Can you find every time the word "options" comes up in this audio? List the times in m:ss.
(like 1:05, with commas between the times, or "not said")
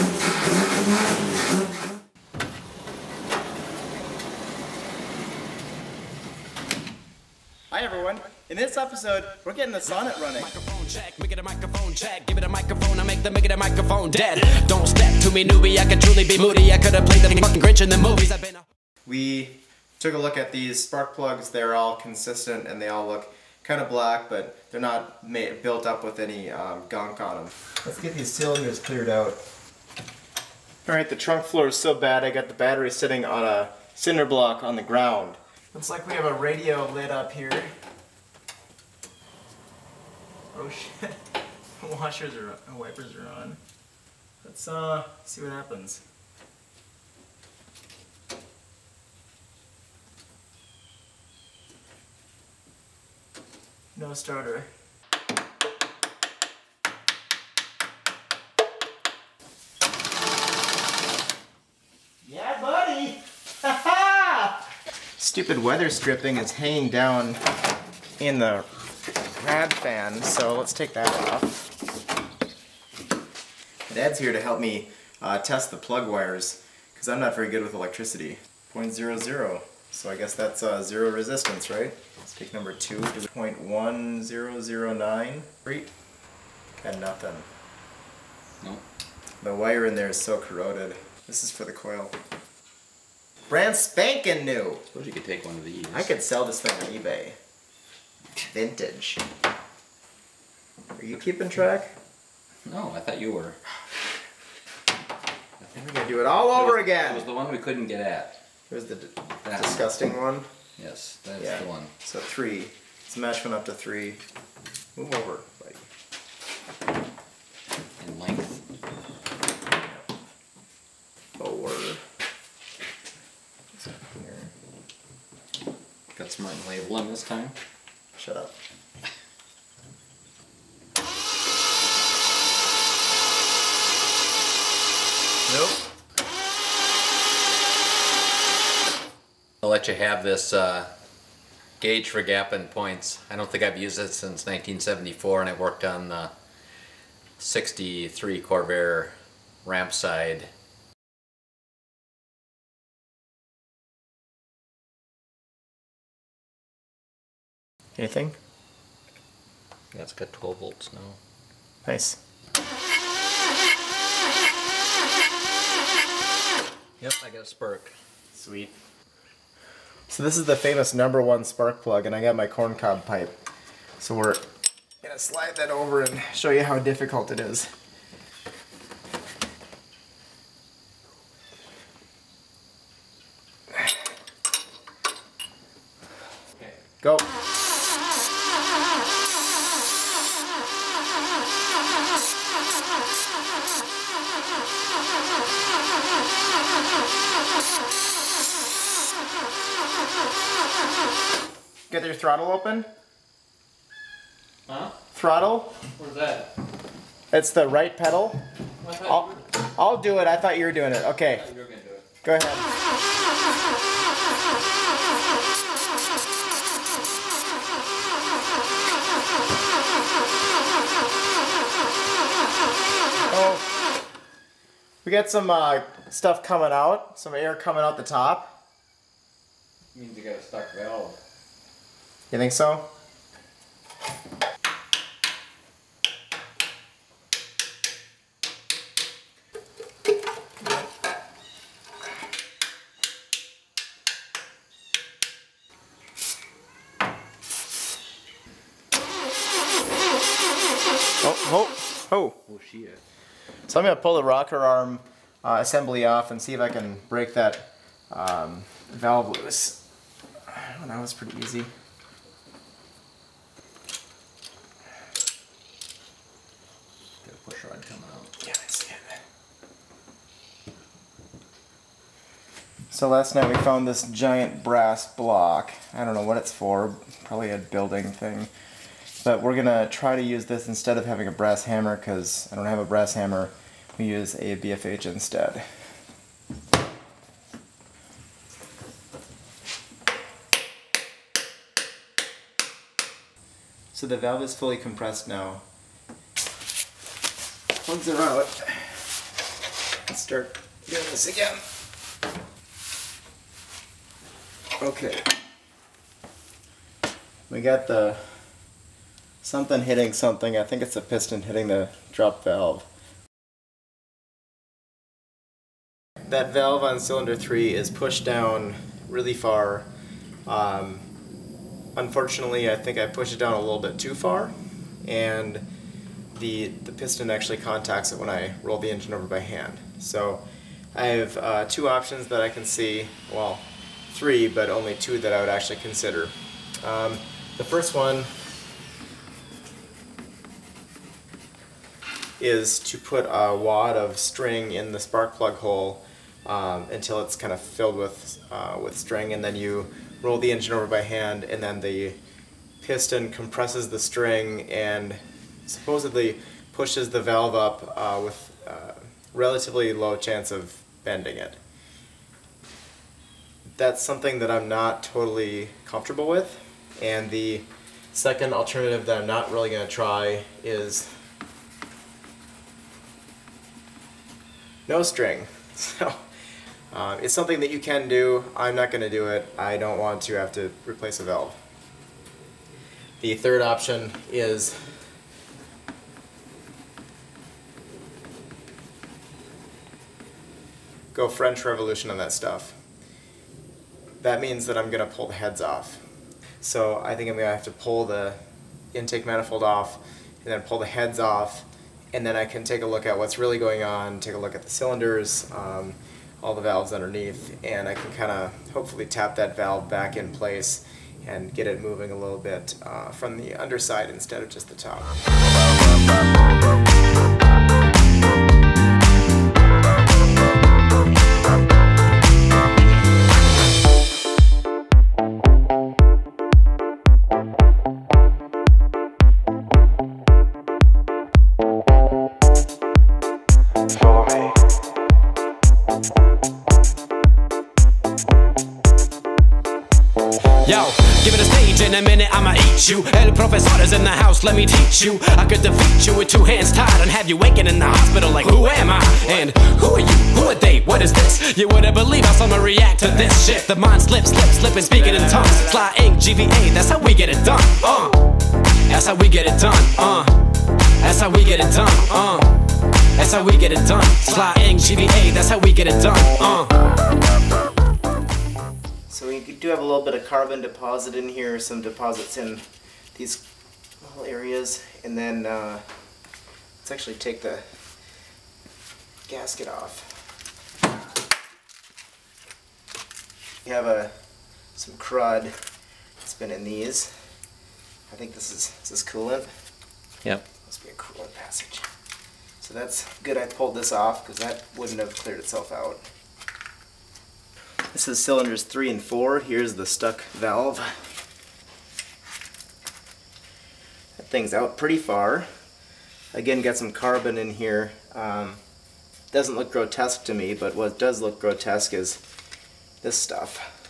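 5:31, 6:23.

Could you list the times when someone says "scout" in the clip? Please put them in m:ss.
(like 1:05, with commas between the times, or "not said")
not said.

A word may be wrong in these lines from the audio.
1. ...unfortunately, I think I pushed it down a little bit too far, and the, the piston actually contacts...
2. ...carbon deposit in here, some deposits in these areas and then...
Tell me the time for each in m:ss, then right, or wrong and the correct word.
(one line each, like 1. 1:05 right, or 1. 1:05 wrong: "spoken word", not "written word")
1. 5:21 right
2. 7:50 right.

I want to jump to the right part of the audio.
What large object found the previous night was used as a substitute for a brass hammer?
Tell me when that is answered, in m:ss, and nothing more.
4:34.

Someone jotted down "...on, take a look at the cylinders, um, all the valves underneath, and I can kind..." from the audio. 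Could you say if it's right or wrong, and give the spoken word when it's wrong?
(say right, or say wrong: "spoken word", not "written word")
right.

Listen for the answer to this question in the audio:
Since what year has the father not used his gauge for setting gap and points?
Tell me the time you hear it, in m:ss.
2:24.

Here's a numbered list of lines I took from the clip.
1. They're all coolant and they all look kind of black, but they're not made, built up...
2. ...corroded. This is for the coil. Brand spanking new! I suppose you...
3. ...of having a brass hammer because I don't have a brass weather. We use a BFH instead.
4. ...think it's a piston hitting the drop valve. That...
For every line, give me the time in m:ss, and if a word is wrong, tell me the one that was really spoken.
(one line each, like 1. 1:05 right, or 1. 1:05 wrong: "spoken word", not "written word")
1. 0:21 wrong: "consistent", not "coolant"
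2. 1:30 right
3. 4:40 wrong: "hammer", not "weather"
4. 5:10 right.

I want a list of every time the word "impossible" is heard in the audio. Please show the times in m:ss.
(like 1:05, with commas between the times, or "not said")
not said.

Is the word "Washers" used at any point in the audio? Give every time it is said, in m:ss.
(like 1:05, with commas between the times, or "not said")
0:41.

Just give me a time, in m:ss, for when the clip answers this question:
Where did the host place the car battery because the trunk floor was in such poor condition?
0:33.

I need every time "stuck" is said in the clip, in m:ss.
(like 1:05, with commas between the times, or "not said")
3:50, 8:19.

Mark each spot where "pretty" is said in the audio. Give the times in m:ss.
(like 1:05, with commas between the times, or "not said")
4:21, 8:24.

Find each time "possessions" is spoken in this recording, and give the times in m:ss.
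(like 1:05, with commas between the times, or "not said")
not said.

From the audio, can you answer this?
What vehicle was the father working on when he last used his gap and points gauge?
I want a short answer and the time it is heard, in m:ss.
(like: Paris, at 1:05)
63 Corvair Rampside, at 2:27.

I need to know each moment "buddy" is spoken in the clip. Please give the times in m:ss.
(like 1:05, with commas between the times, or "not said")
1:02, 1:55.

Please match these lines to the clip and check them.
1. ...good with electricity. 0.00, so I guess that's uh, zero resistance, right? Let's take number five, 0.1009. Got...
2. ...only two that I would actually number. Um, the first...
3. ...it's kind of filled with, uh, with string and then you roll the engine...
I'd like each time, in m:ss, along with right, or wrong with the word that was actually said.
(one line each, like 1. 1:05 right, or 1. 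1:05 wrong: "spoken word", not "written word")
1. 1:17 wrong: "two", not "five"
2. 5:34 wrong: "consider", not "number"
3. 5:47 right.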